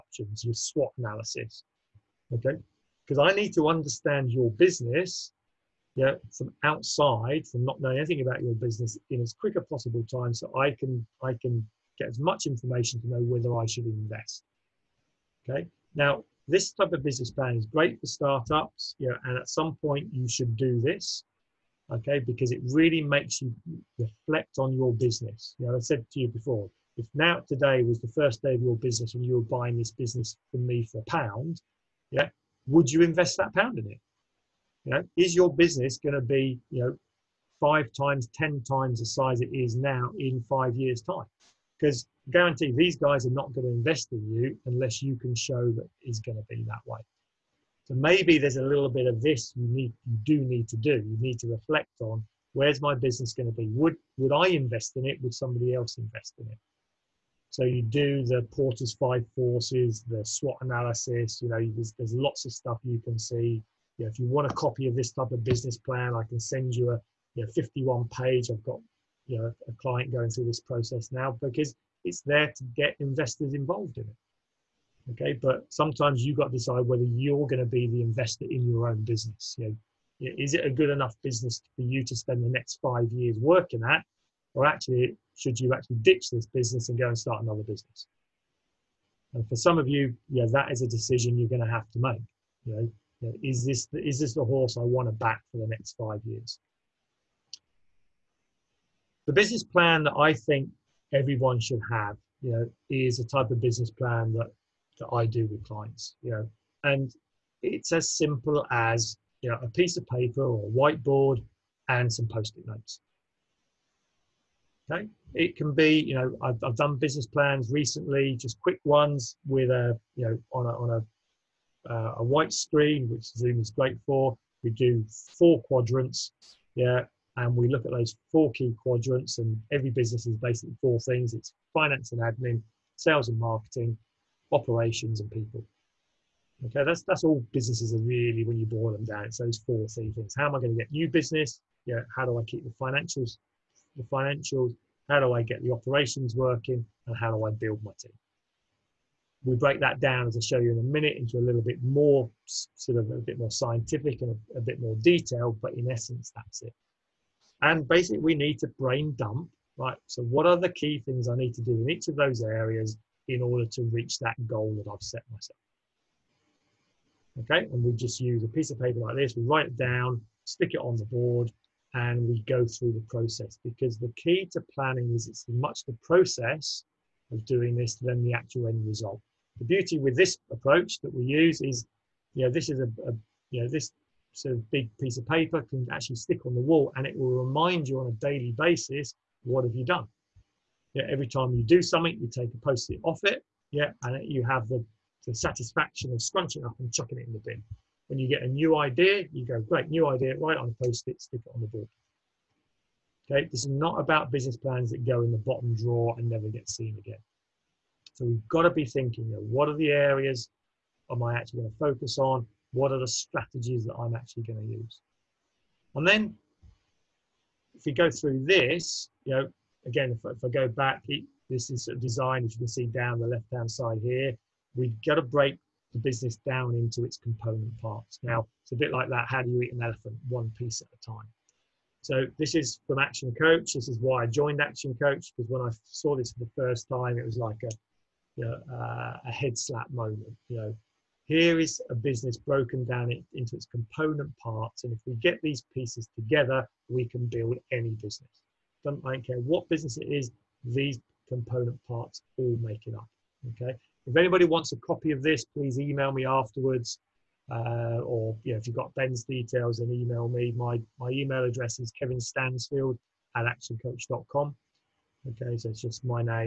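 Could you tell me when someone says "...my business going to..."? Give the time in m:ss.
0:52.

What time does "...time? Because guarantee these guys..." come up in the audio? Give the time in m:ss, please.
0:41.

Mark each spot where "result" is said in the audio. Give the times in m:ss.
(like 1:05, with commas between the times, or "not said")
2:58.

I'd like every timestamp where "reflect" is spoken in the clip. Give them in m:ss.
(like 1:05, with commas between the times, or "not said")
0:23, 0:51.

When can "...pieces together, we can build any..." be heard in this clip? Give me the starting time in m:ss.
4:05.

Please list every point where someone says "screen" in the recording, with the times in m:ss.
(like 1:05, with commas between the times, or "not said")
2:02.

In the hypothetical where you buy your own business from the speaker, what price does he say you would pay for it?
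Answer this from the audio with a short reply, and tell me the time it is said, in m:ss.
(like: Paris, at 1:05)
a pound, at 0:30.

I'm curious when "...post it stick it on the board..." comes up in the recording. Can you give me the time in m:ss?
3:20.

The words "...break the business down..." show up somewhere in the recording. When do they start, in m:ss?
3:45.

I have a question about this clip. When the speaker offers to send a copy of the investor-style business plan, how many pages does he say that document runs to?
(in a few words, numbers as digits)
51.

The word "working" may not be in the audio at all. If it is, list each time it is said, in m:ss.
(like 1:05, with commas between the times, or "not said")
1:23, 2:26.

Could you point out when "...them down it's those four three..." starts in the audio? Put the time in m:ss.
2:18.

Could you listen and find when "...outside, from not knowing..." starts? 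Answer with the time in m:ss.
0:06.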